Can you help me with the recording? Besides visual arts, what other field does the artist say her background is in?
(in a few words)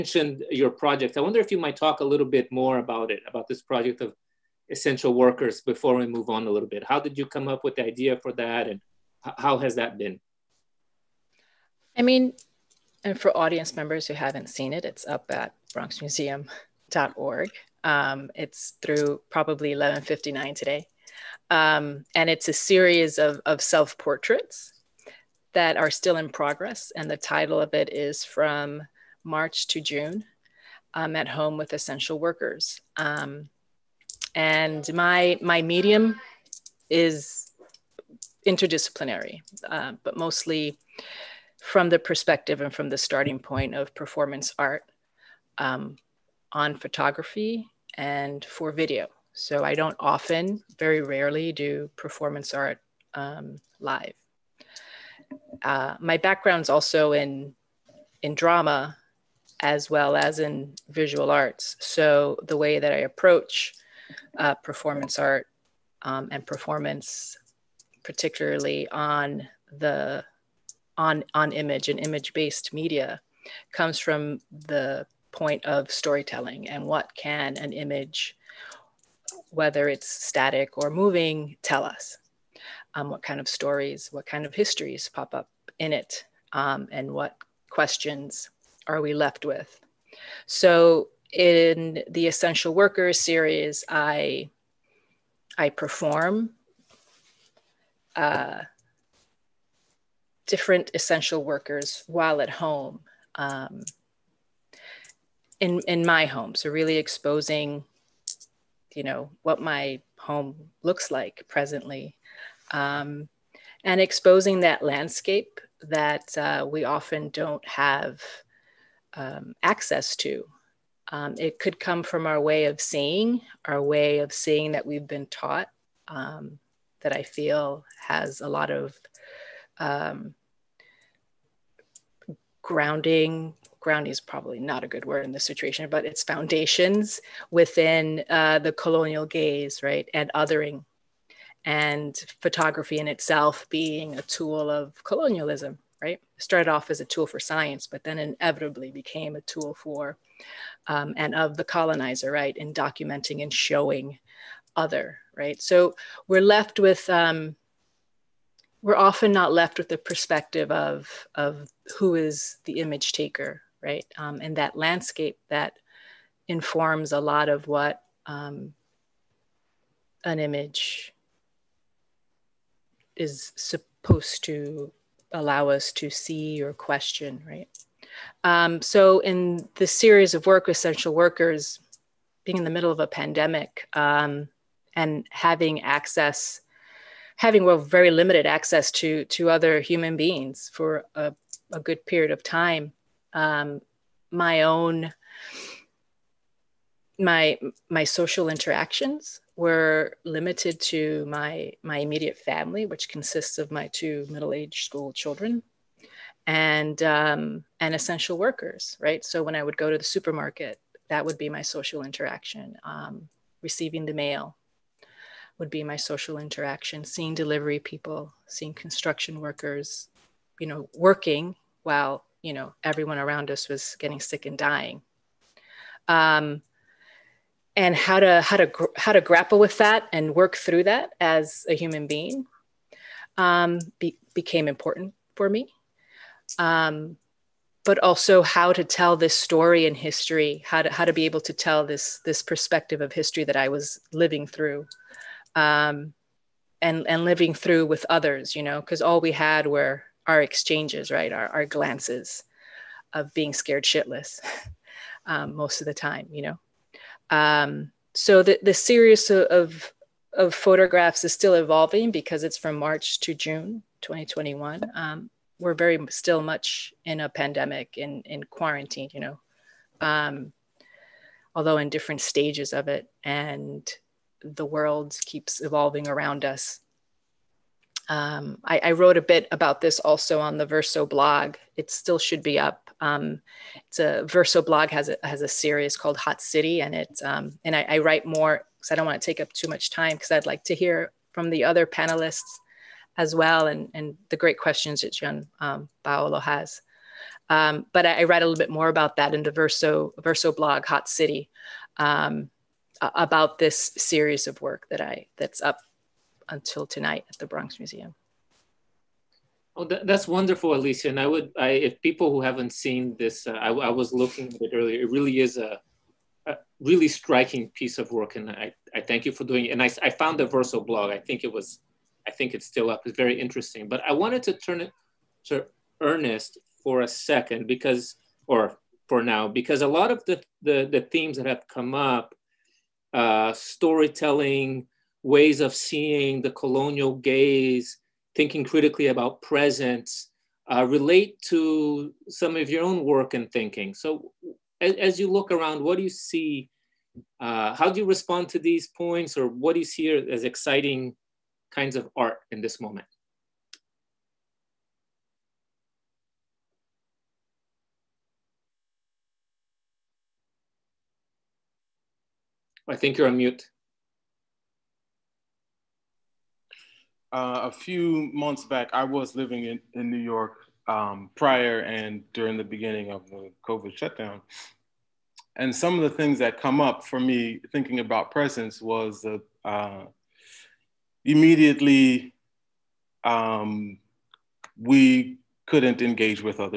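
drama.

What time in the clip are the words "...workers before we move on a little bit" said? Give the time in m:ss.
0:05.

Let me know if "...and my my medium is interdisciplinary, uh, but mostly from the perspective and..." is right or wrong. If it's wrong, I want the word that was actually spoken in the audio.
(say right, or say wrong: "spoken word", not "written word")
right.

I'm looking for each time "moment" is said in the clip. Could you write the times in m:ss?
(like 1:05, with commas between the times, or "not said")
5:52.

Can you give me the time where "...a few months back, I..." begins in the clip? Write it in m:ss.
6:07.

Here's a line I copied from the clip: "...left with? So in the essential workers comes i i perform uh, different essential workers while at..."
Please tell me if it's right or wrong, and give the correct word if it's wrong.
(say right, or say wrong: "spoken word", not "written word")
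wrong: "series", not "comes".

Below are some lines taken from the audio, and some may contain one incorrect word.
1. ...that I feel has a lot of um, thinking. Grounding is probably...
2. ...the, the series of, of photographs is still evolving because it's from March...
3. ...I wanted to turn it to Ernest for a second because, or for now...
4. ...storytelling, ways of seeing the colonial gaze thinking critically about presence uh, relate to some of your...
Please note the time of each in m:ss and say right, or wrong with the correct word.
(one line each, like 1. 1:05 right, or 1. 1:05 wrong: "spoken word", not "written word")
1. 2:07 wrong: "grounding", not "thinking"
2. 4:18 right
3. 5:24 right
4. 5:33 right.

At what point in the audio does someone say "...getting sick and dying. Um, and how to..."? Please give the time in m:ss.
3:43.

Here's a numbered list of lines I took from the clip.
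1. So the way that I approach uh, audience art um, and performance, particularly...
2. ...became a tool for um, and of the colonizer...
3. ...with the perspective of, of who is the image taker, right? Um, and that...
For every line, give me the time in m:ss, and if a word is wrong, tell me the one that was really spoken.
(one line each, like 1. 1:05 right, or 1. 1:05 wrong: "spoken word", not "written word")
1. 1:01 wrong: "performance", not "audience"
2. 2:28 right
3. 2:39 right.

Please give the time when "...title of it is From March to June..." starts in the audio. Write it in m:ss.
0:27.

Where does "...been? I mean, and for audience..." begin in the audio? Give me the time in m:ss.
0:09.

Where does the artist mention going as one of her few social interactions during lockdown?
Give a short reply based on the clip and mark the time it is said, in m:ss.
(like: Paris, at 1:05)
the supermarket, at 3:29.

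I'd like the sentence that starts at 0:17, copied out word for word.
Um, it's through probably 1159 today.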